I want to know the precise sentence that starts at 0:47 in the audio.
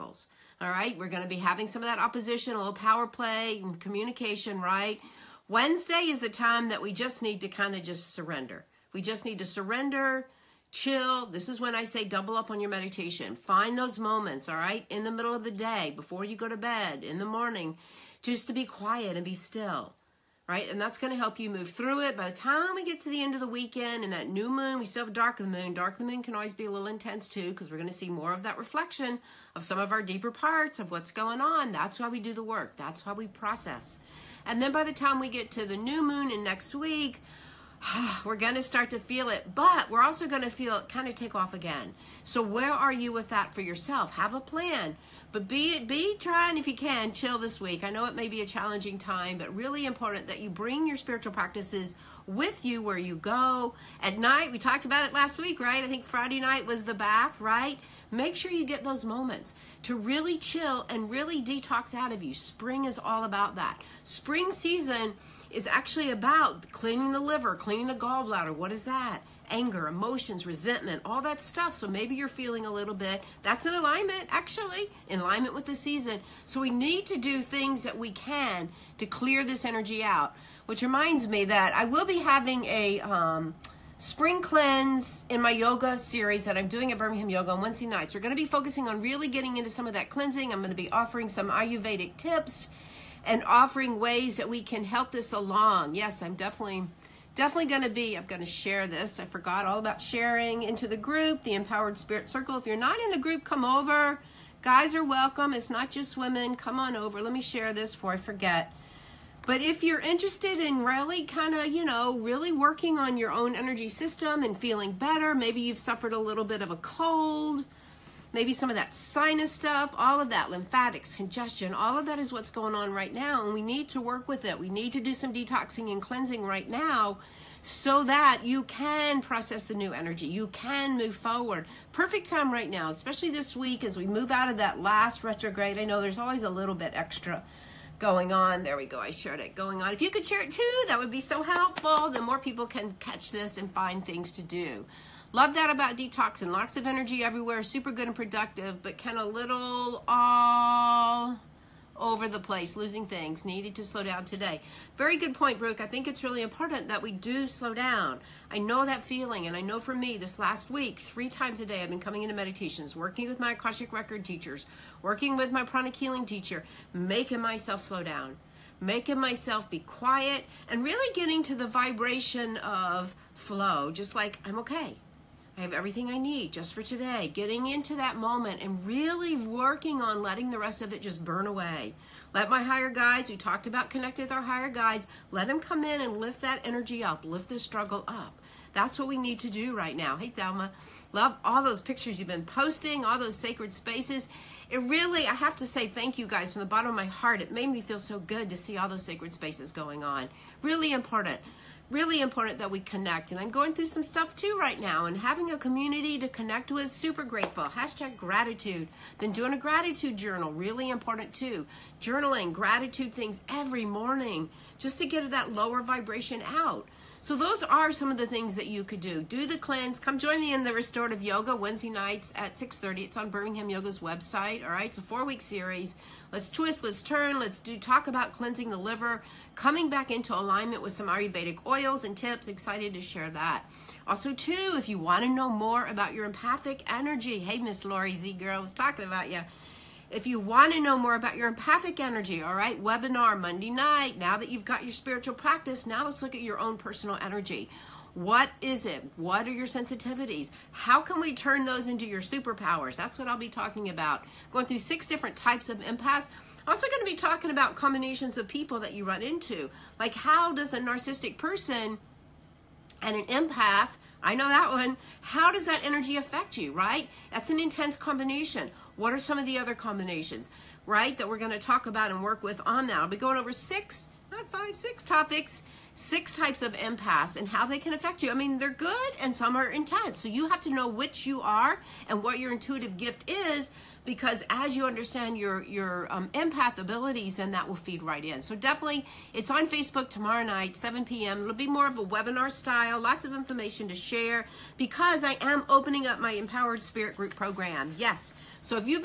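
I know it may be a challenging time, but really important that you bring your spiritual practices with you where you go.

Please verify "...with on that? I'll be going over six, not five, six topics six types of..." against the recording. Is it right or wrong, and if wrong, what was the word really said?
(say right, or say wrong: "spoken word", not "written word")
right.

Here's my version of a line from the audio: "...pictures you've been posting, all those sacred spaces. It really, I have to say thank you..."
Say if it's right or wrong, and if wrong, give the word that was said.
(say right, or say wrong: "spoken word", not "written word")
right.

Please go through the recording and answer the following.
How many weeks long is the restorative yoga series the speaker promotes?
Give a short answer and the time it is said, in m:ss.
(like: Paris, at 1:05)
4, at 3:45.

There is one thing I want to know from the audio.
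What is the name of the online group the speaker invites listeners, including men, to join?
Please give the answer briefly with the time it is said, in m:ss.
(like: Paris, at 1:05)
Empowered Spirit Circle, at 1:41.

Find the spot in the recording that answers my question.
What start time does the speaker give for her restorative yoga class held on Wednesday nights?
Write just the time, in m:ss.
3:42.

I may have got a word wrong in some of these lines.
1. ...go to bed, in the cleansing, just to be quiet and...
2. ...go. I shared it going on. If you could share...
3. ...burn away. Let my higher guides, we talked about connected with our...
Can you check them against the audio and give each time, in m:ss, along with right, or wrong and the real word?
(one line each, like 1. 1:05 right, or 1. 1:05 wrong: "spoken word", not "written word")
1. 0:16 wrong: "morning", not "cleansing"
2. 2:18 right
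3. 3:01 right.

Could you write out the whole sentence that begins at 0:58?
Make sure you get those moments to really chill and really detox out of you.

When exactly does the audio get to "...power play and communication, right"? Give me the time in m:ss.
0:02.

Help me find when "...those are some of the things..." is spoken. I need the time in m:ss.
3:37.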